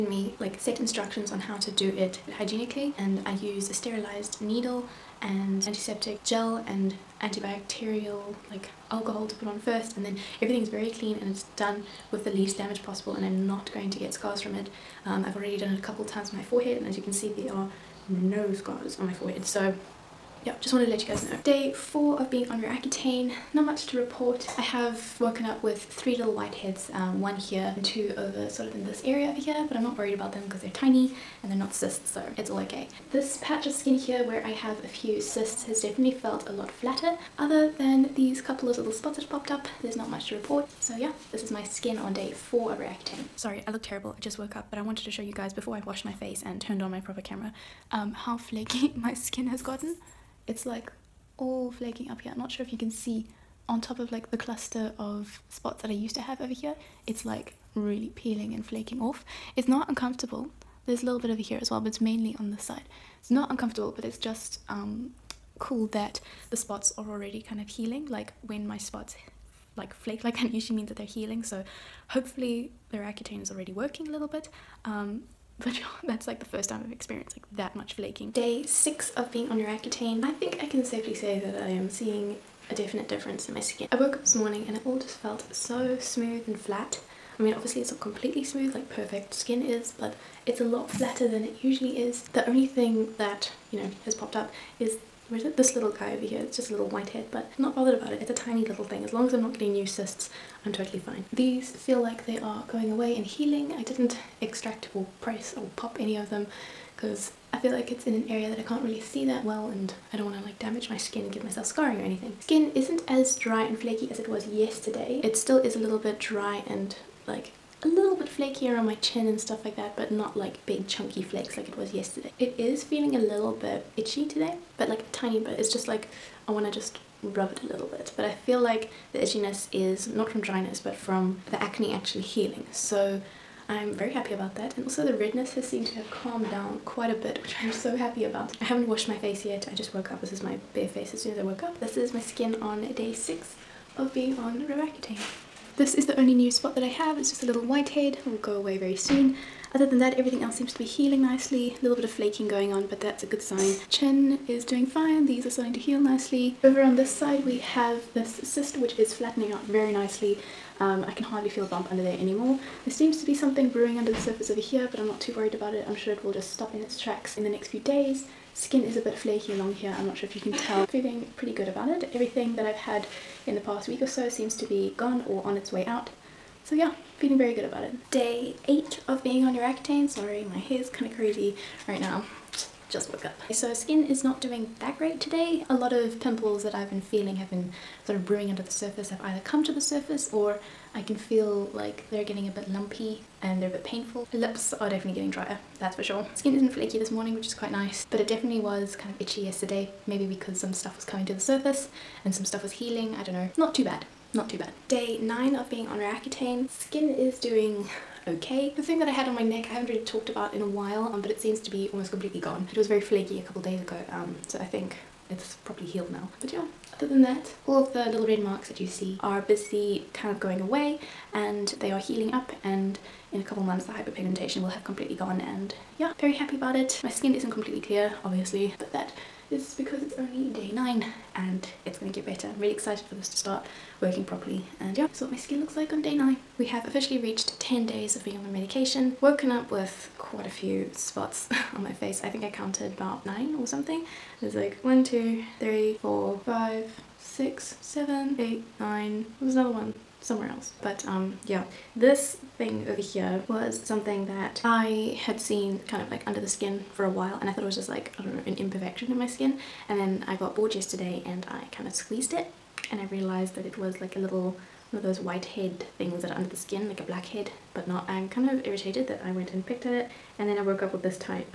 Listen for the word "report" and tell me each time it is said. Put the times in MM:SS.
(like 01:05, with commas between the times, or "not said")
00:23, 00:40.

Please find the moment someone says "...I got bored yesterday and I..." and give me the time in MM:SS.
04:20.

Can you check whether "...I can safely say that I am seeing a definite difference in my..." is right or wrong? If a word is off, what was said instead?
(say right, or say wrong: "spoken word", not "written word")
right.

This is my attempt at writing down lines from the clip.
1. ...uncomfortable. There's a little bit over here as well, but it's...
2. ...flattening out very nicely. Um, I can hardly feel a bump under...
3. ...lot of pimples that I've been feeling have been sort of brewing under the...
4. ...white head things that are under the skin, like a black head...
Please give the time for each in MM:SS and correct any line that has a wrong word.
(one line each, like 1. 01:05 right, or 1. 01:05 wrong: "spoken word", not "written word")
1. 00:59 right
2. 02:39 right
3. 03:05 right
4. 04:25 right.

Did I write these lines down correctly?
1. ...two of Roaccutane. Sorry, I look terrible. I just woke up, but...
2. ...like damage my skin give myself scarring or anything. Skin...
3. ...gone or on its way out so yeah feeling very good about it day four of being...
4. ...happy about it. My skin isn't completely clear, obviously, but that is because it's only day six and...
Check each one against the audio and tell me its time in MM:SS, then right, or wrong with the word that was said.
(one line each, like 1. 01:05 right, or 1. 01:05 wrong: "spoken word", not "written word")
1. 00:42 wrong: "four", not "two"
2. 01:50 right
3. 02:54 wrong: "eight", not "four"
4. 03:46 wrong: "nine", not "six".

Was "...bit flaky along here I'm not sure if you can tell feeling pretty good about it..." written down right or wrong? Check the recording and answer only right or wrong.
right.